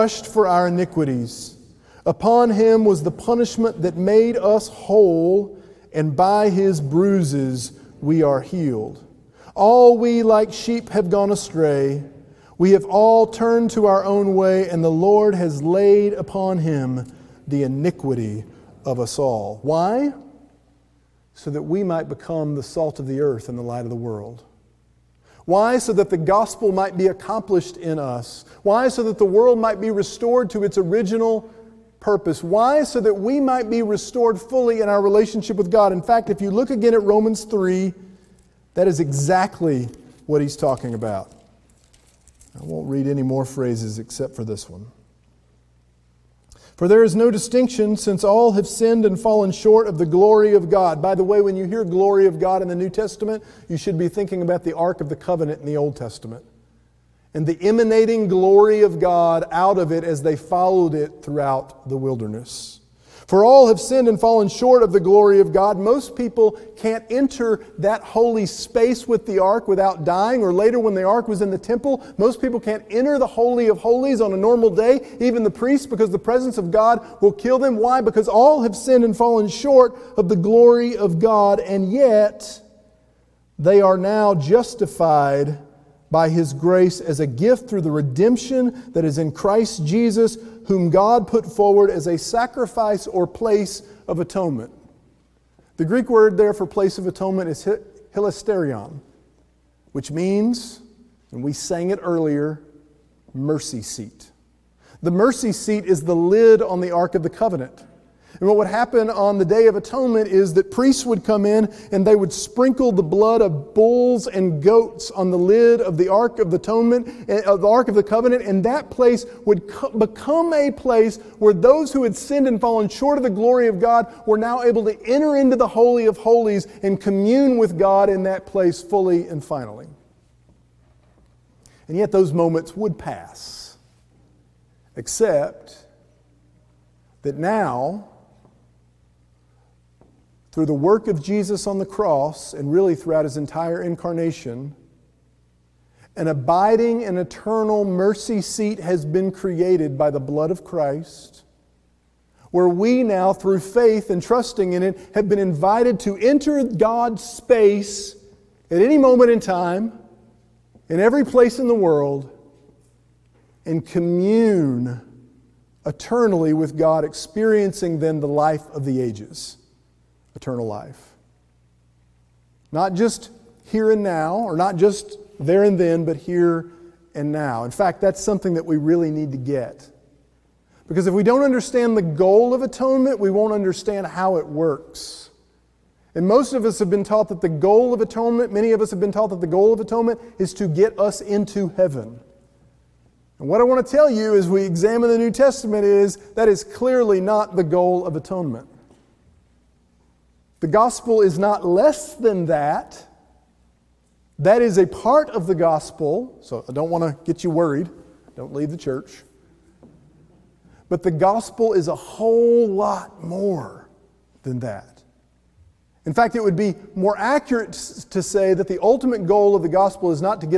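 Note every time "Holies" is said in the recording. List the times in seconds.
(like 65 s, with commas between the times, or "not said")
73 s, 126 s.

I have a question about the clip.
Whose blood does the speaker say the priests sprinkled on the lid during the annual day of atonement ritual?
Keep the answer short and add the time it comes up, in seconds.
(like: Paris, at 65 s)
bulls and goats, at 113 s.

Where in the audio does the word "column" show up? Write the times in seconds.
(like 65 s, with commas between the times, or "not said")
not said.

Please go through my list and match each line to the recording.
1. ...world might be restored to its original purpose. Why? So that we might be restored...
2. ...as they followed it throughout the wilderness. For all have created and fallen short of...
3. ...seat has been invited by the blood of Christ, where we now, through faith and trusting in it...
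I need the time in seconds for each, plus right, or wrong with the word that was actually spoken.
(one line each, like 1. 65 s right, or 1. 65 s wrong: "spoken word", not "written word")
1. 29 s right
2. 60 s wrong: "sinned", not "created"
3. 148 s wrong: "created", not "invited".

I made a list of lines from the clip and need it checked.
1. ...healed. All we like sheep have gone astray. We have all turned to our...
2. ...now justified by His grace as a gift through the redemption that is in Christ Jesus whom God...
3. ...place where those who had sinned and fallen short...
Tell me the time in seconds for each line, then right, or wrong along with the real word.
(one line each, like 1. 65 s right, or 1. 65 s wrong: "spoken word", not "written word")
1. 8 s right
2. 83 s right
3. 120 s right.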